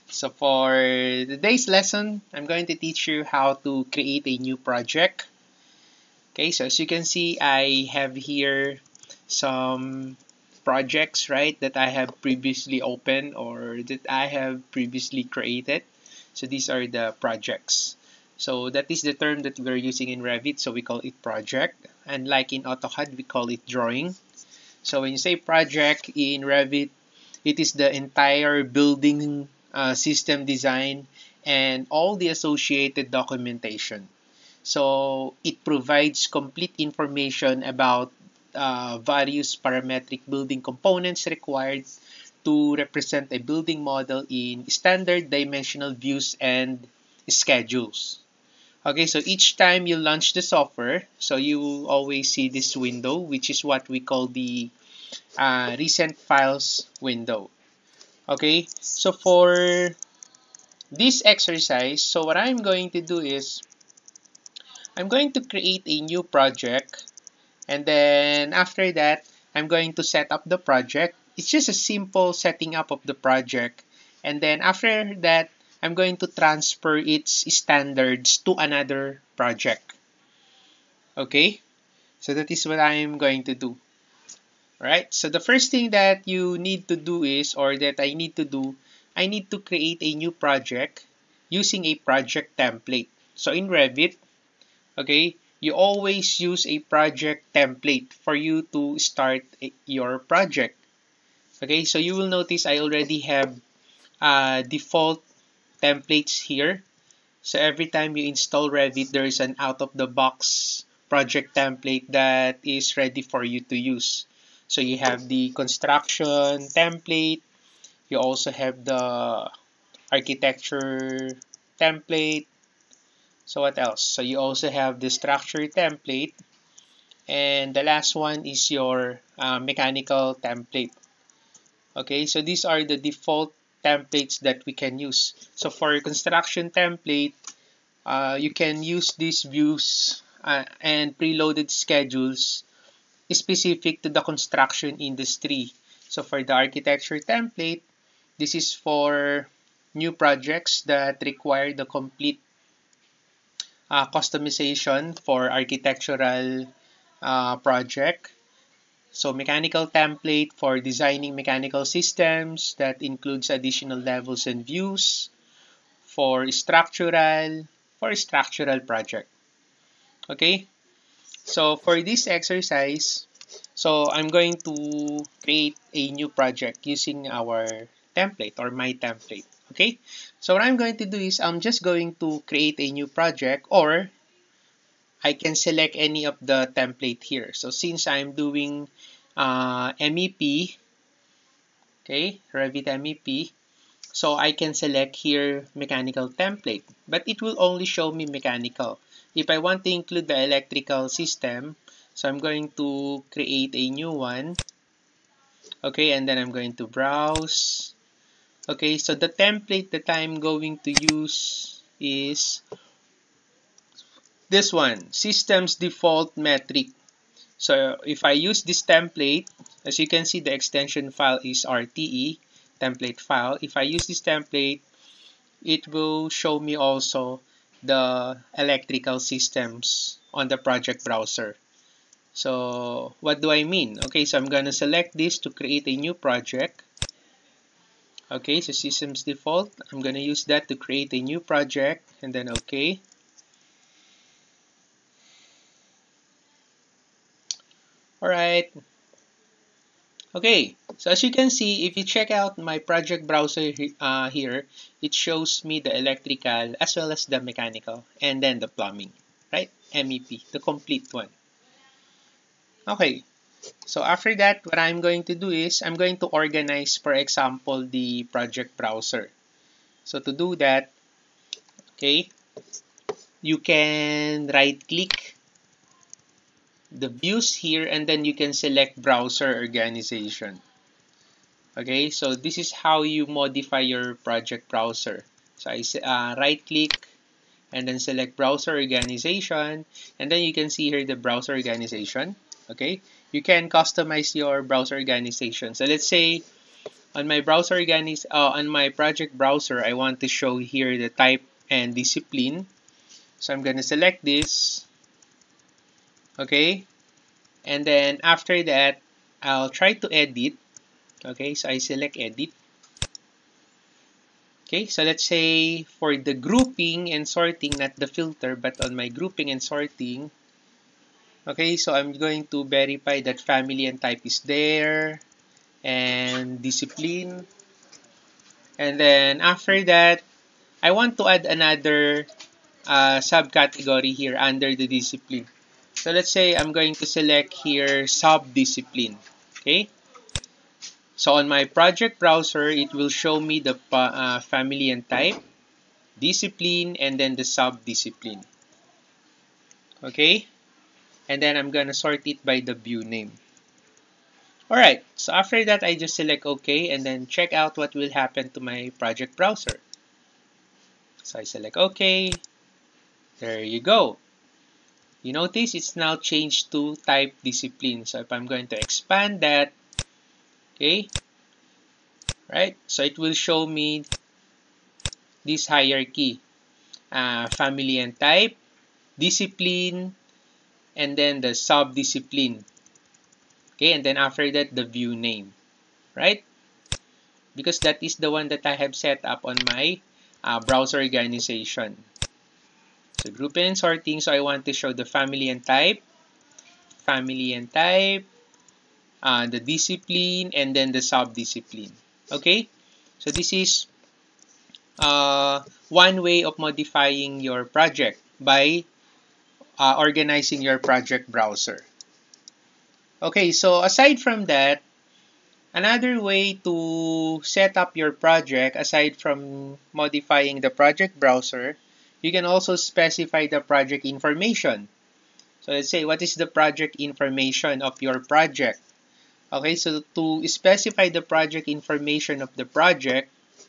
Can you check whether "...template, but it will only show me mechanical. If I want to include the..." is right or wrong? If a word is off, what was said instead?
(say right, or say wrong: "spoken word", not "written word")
right.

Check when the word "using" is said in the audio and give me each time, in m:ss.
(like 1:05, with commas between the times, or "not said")
0:19, 1:31, 2:56.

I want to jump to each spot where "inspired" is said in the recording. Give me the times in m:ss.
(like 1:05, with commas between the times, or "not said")
not said.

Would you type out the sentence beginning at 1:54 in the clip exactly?
So you have the construction template.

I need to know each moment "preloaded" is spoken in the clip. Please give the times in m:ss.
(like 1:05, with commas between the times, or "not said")
2:21.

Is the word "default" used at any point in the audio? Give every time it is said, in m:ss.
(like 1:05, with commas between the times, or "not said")
1:44, 2:12, 3:35, 3:59.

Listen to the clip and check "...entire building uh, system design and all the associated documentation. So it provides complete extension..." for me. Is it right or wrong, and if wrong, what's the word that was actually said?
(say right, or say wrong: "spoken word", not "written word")
wrong: "information", not "extension".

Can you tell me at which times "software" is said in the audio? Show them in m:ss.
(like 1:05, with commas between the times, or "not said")
0:50.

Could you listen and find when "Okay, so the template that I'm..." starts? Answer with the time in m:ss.
3:28.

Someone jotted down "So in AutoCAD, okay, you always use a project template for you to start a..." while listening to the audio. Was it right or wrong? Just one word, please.
wrong.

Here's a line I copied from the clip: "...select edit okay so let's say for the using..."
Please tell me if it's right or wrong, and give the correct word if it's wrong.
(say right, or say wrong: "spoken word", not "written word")
wrong: "grouping", not "using".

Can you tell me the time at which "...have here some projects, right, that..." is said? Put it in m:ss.
0:07.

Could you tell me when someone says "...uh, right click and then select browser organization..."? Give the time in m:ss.
4:46.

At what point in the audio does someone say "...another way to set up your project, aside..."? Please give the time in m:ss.
6:55.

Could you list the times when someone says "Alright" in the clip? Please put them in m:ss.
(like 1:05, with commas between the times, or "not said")
1:24, 4:08, 5:54.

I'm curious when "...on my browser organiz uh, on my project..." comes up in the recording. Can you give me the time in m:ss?
4:57.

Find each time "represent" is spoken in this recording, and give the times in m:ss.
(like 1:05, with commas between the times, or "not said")
0:42.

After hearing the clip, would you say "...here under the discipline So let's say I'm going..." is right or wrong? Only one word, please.
right.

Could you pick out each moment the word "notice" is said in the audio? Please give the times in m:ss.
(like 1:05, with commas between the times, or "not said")
1:42, 6:05.